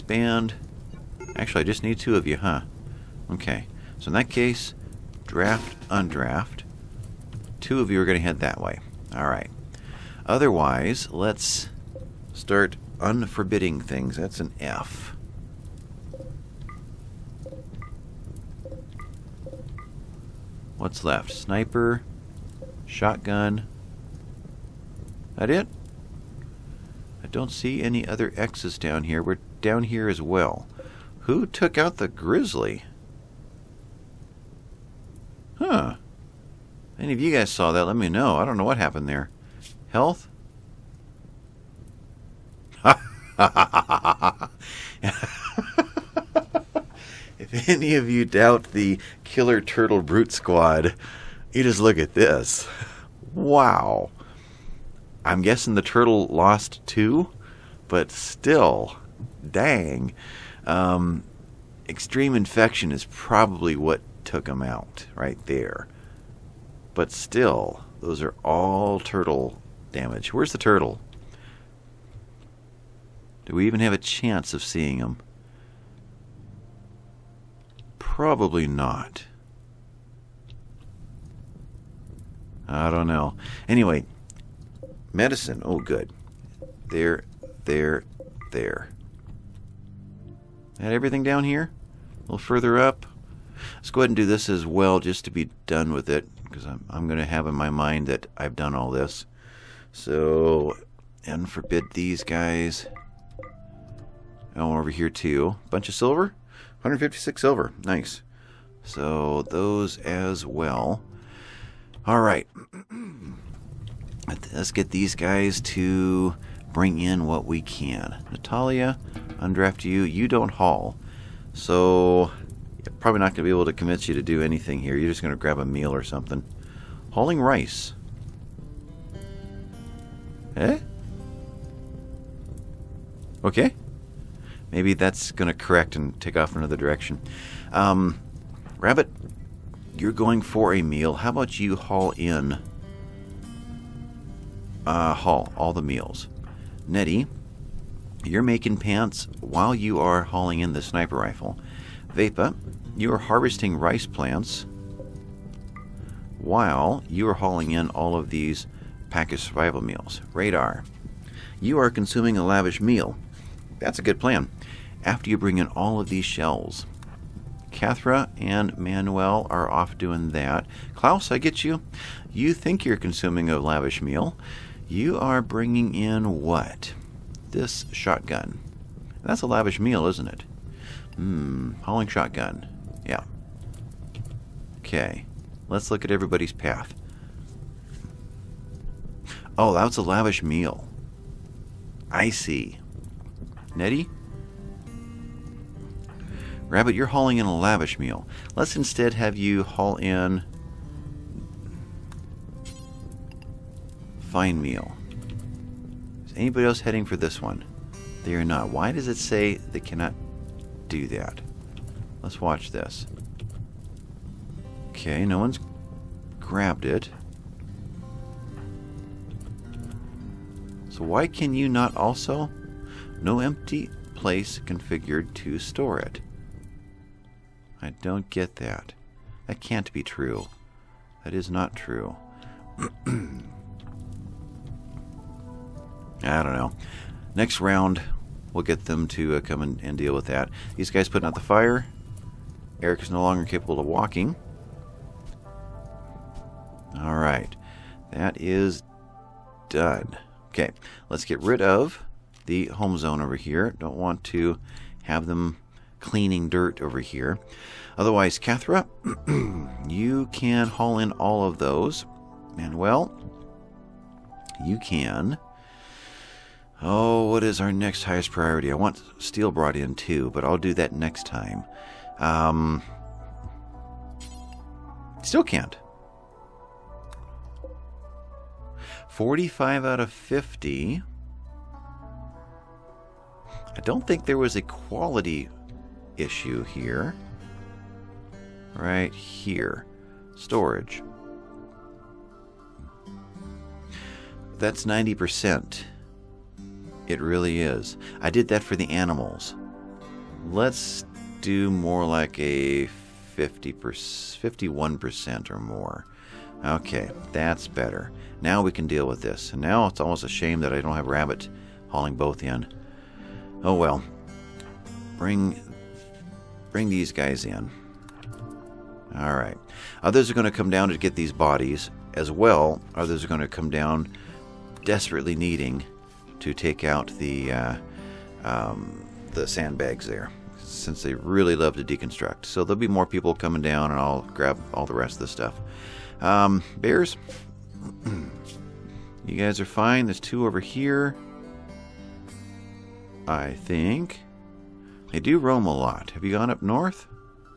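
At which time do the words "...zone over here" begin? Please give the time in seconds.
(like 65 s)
252 s.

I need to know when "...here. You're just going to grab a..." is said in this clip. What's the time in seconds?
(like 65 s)
124 s.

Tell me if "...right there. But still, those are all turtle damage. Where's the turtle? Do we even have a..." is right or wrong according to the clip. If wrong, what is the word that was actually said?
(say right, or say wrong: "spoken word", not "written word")
right.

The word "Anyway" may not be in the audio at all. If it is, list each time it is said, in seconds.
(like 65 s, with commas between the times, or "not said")
83 s.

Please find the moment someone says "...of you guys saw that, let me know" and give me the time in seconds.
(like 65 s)
37 s.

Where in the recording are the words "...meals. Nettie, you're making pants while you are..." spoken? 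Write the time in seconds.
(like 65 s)
145 s.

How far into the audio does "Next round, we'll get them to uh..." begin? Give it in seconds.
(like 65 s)
237 s.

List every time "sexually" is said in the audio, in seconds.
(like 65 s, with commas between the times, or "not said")
not said.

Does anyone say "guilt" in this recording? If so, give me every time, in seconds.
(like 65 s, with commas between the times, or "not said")
not said.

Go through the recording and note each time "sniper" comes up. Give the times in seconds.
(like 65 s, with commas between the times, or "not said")
21 s, 150 s.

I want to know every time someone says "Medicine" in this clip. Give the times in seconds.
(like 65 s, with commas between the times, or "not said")
85 s.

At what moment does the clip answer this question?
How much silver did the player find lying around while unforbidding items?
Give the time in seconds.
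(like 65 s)
106 s.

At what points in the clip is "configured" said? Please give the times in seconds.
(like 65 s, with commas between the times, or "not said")
224 s.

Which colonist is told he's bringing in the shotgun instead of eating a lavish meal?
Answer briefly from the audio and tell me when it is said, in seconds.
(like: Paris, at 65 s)
Klaus, at 170 s.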